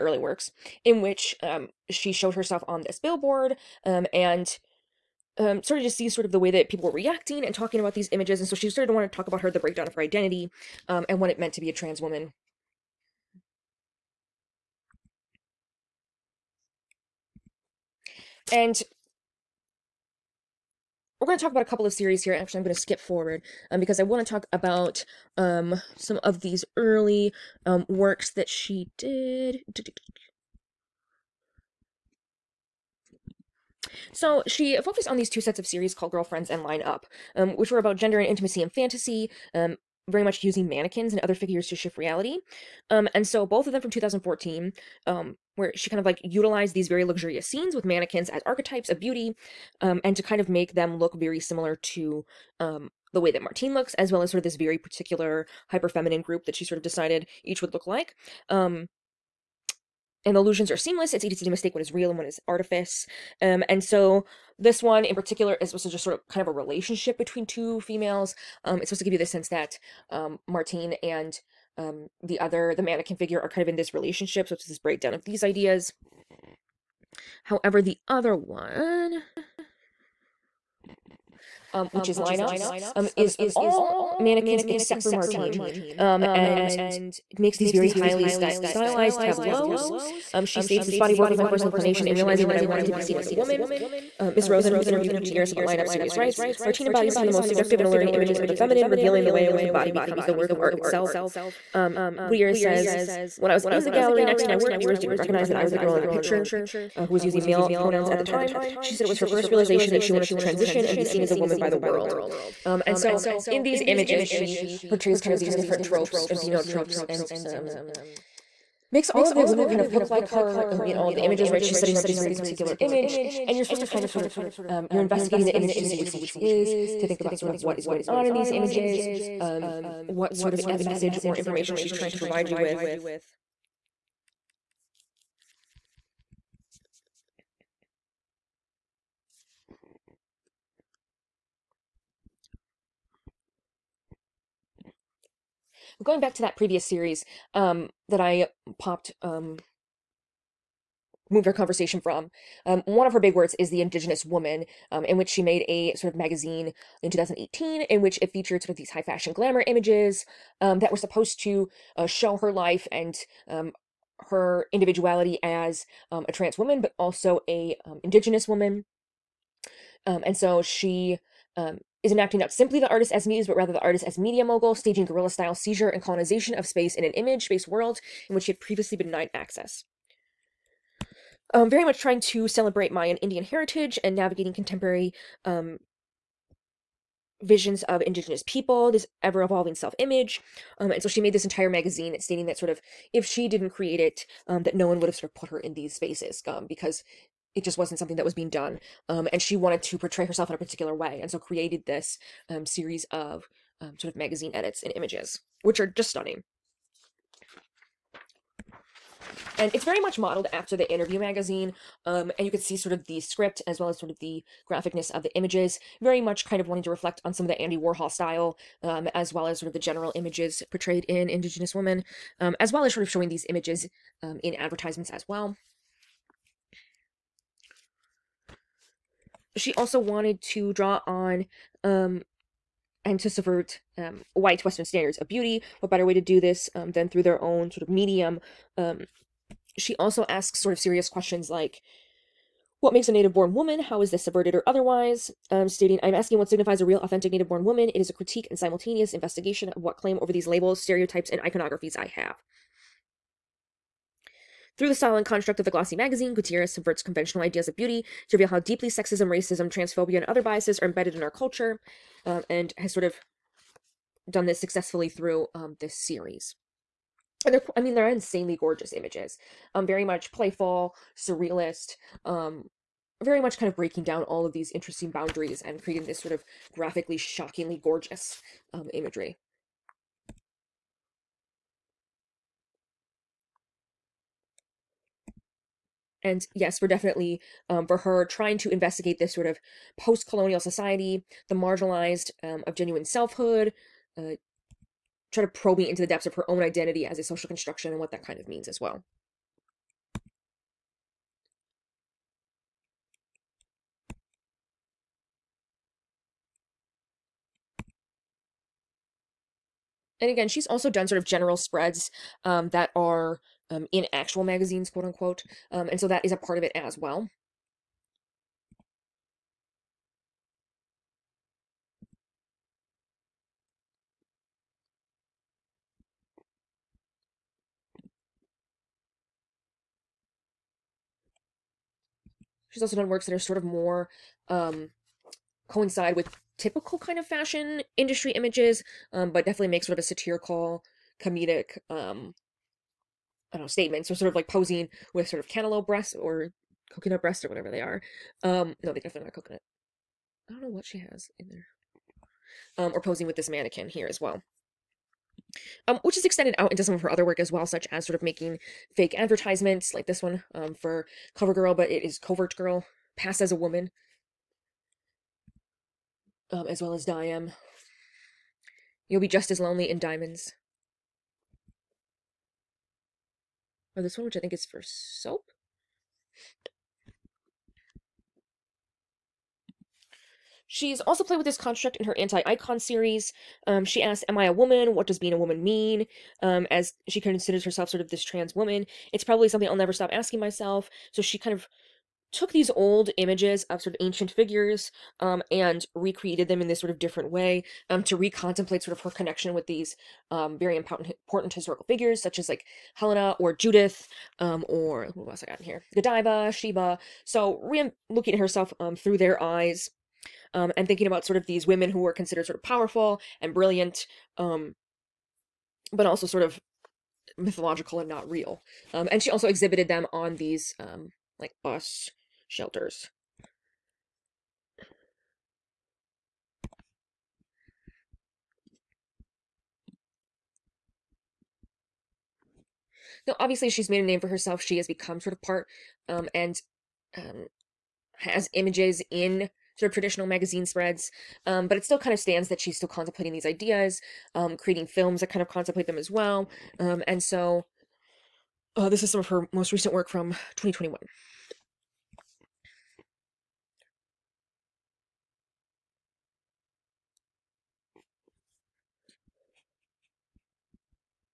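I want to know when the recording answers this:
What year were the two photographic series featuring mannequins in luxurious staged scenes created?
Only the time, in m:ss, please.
0:43.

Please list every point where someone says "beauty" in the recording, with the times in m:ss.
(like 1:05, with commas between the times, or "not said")
0:49, 3:55, 4:17.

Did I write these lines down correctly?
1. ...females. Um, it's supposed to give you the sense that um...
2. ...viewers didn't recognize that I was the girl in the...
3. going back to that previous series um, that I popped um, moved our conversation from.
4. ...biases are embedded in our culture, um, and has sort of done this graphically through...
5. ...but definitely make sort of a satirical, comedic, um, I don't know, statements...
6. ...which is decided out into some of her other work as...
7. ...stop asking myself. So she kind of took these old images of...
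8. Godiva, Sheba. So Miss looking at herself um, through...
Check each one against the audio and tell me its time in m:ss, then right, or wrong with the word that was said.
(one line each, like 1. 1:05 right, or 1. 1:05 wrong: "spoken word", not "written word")
1. 1:07 right
2. 1:44 right
3. 2:26 right
4. 4:20 wrong: "successfully", not "graphically"
5. 5:39 right
6. 5:56 wrong: "extended", not "decided"
7. 6:29 right
8. 6:45 wrong: "Rhea", not "Miss".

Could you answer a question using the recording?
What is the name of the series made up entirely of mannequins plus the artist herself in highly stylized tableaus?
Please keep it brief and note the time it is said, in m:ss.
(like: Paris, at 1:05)
Line Up, at 0:36.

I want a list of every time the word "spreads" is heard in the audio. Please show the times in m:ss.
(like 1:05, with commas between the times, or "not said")
5:11, 7:20.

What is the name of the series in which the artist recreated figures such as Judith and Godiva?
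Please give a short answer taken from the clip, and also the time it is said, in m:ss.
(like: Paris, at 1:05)
Anti Icon, at 6:22.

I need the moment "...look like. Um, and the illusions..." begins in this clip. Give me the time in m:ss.
0:57.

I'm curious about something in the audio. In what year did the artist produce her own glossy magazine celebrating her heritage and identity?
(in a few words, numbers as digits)
2018.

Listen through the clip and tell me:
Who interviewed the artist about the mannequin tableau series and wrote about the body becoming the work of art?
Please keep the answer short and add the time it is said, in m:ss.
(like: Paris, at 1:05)
Miss Rosen, at 1:34.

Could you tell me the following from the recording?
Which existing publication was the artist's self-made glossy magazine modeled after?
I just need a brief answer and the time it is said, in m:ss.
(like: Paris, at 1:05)
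Interview magazine, at 3:30.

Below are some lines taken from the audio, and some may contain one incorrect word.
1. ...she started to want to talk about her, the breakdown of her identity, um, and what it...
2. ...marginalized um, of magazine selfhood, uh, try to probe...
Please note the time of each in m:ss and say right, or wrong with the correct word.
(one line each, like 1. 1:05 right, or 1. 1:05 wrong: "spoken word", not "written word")
1. 0:08 right
2. 4:51 wrong: "genuine", not "magazine".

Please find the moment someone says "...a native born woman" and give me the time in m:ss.
4:03.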